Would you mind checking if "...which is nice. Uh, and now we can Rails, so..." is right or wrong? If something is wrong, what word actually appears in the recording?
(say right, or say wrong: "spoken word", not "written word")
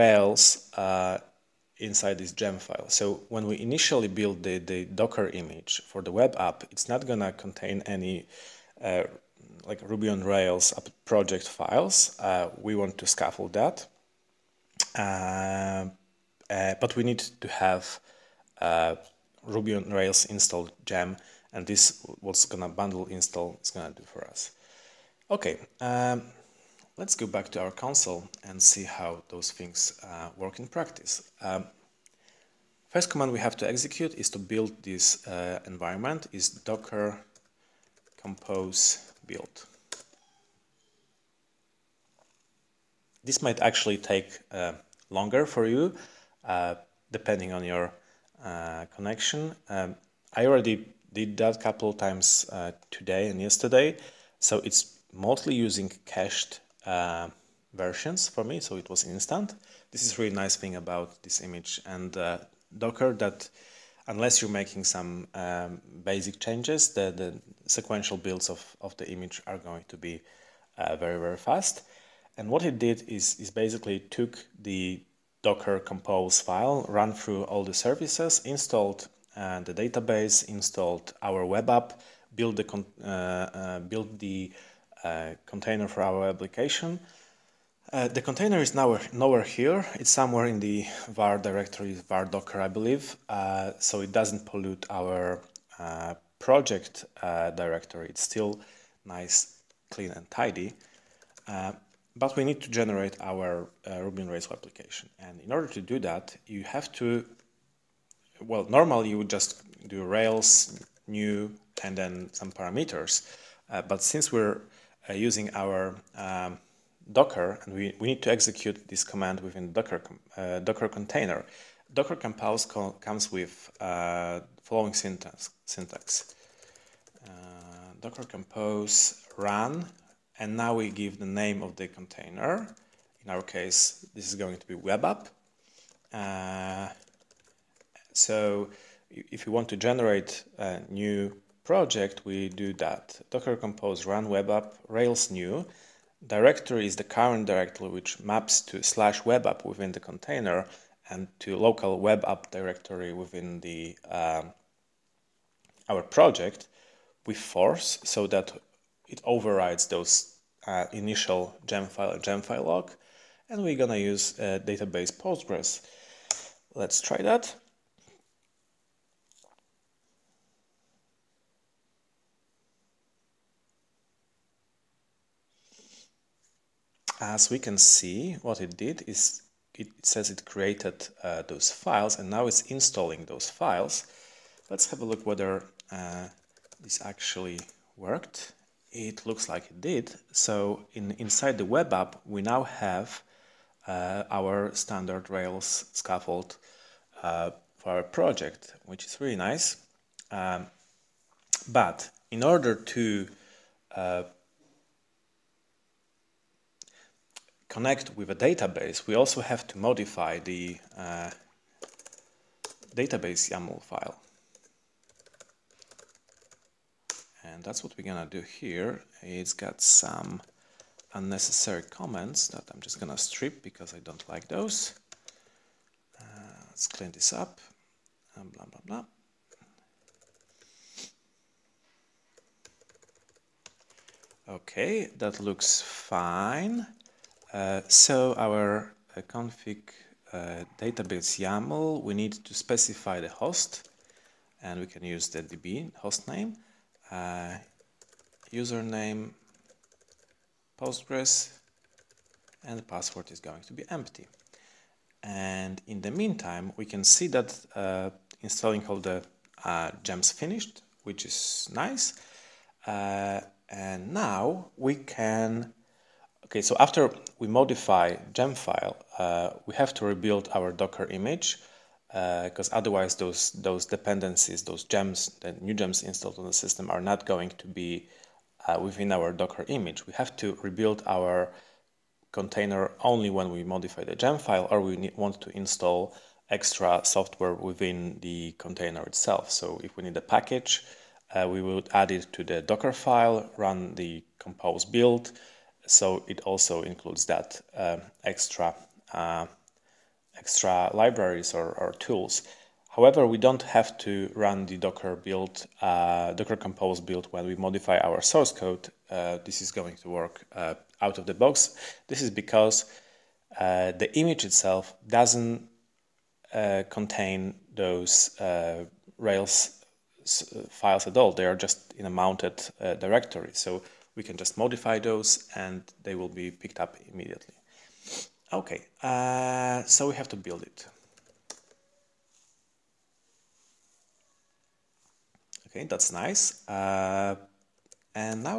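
wrong: "Okay", not "Rails".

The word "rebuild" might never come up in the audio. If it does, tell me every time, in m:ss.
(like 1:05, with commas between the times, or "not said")
4:30, 4:40.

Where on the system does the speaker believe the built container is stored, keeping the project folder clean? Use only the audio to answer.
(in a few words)
var docker.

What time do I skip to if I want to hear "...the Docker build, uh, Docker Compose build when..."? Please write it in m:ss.
5:04.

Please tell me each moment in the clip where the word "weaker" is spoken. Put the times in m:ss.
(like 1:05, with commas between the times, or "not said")
not said.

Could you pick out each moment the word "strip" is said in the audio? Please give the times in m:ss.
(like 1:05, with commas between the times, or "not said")
3:43.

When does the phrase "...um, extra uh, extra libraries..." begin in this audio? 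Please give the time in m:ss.
4:57.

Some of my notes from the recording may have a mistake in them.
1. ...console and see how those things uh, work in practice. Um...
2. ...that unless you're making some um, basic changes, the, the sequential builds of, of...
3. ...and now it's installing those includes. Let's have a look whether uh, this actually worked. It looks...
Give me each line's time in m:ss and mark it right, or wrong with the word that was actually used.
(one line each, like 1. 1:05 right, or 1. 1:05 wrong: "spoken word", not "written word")
1. 0:27 right
2. 1:03 right
3. 3:02 wrong: "files", not "includes".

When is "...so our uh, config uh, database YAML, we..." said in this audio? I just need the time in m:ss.
3:57.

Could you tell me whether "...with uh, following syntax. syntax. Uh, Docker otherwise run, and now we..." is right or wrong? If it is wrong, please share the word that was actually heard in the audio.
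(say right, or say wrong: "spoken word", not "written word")
wrong: "compose", not "otherwise".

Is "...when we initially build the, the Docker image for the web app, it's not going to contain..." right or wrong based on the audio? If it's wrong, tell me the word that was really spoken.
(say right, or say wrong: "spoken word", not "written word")
right.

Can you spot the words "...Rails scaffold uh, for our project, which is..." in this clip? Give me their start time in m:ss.
3:15.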